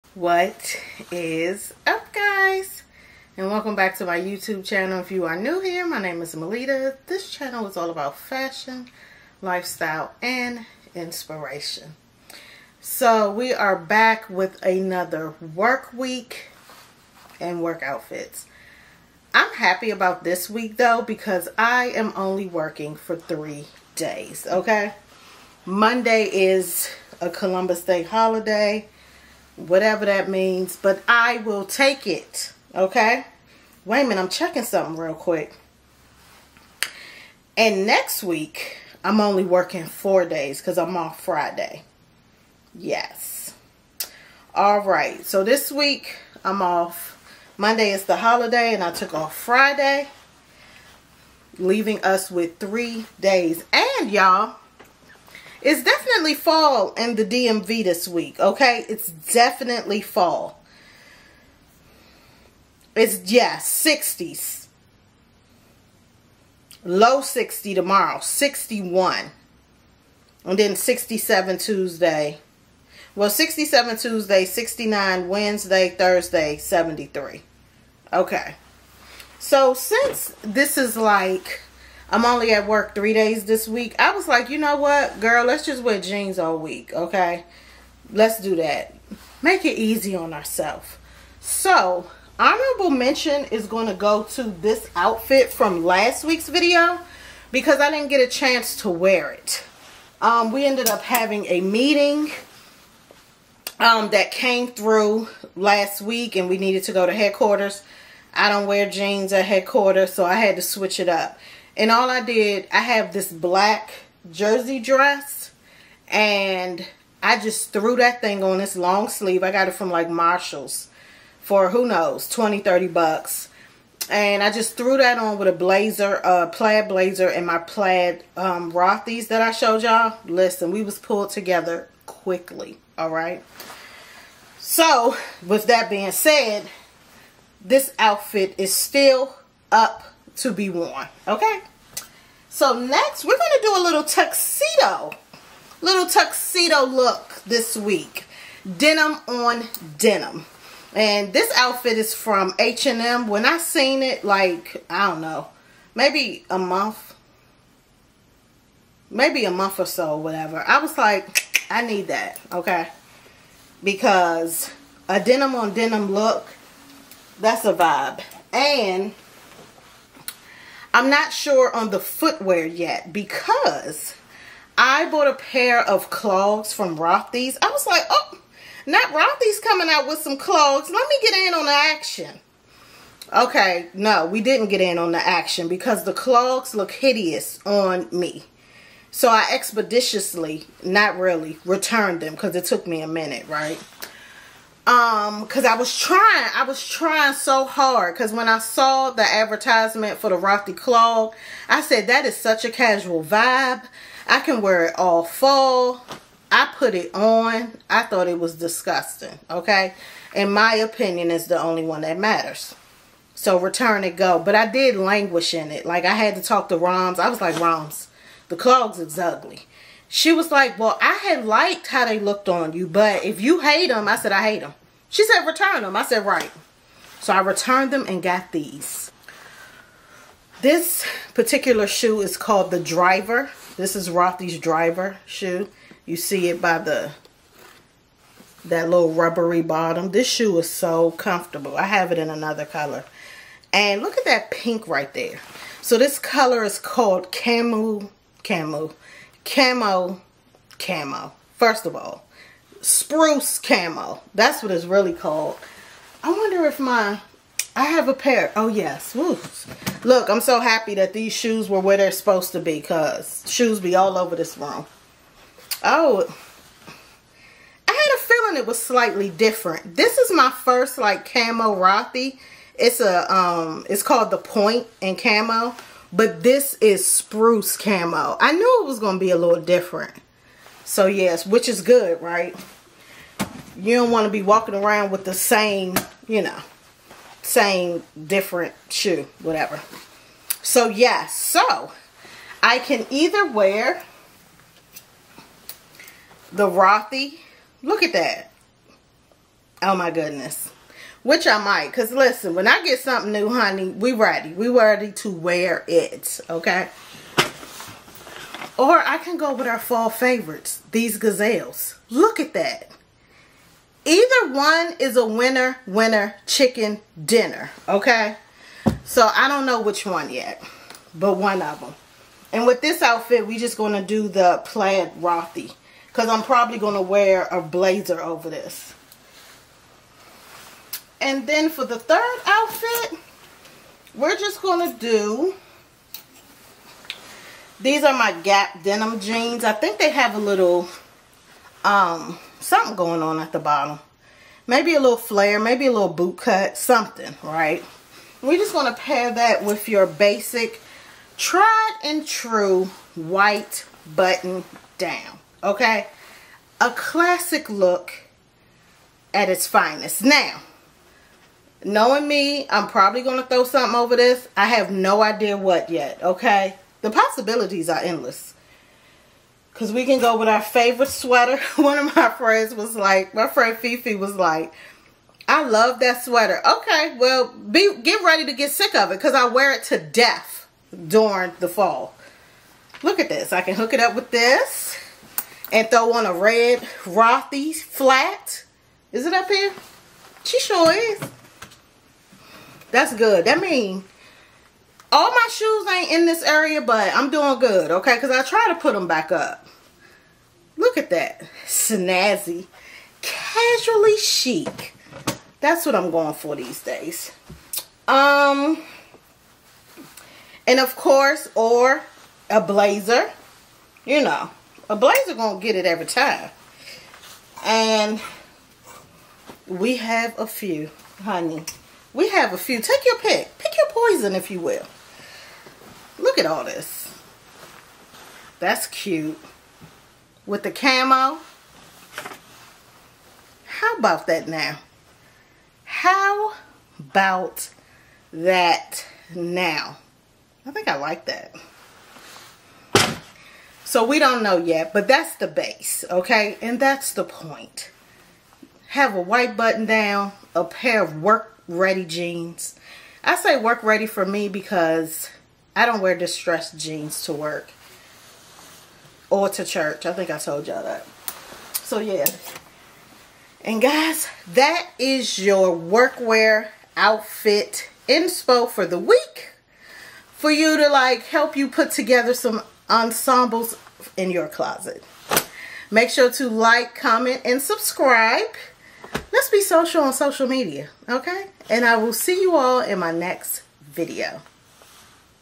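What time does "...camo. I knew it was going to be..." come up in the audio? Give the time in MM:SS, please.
04:37.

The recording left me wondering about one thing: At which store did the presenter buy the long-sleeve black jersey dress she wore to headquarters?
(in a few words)
Marshall's.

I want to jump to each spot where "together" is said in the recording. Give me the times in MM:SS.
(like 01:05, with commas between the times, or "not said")
02:11, 07:51.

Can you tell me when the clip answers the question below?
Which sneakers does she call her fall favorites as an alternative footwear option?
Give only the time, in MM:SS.
05:11.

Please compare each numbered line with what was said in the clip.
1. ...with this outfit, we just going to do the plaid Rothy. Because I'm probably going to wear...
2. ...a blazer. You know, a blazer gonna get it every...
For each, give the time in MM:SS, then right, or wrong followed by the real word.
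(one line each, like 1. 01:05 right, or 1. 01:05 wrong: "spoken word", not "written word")
1. 05:22 right
2. 06:52 right.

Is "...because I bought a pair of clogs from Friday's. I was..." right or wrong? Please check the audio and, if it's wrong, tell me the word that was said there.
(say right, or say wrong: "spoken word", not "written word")
wrong: "Rothy", not "Friday".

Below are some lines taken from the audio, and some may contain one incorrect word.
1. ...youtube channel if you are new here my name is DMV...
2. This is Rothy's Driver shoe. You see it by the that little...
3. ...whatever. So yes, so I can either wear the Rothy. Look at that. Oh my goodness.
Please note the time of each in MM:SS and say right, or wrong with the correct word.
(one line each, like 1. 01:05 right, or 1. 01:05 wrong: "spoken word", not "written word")
1. 00:04 wrong: "Maletta", not "DMV"
2. 03:53 right
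3. 04:49 right.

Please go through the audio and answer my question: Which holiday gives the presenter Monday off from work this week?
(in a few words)
Columbus Day.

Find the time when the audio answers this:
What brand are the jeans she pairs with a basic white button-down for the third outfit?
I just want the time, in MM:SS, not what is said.
05:38.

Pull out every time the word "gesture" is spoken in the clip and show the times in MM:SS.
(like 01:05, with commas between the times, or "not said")
not said.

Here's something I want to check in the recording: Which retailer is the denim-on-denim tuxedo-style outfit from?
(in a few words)
H&M.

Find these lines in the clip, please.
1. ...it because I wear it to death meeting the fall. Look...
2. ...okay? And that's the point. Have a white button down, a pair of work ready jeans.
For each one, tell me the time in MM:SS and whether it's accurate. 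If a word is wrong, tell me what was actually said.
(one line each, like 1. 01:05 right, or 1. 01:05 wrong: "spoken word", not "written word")
1. 06:19 wrong: "during", not "meeting"
2. 07:26 right.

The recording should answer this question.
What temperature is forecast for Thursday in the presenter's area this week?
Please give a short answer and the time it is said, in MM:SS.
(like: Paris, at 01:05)
73, at 01:16.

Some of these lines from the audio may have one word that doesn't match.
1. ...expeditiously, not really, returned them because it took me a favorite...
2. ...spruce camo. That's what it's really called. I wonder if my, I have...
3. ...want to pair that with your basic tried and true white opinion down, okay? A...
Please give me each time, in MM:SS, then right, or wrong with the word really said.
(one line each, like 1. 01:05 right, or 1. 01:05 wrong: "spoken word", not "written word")
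1. 03:09 wrong: "minute", not "favorite"
2. 04:12 right
3. 05:48 wrong: "button", not "opinion".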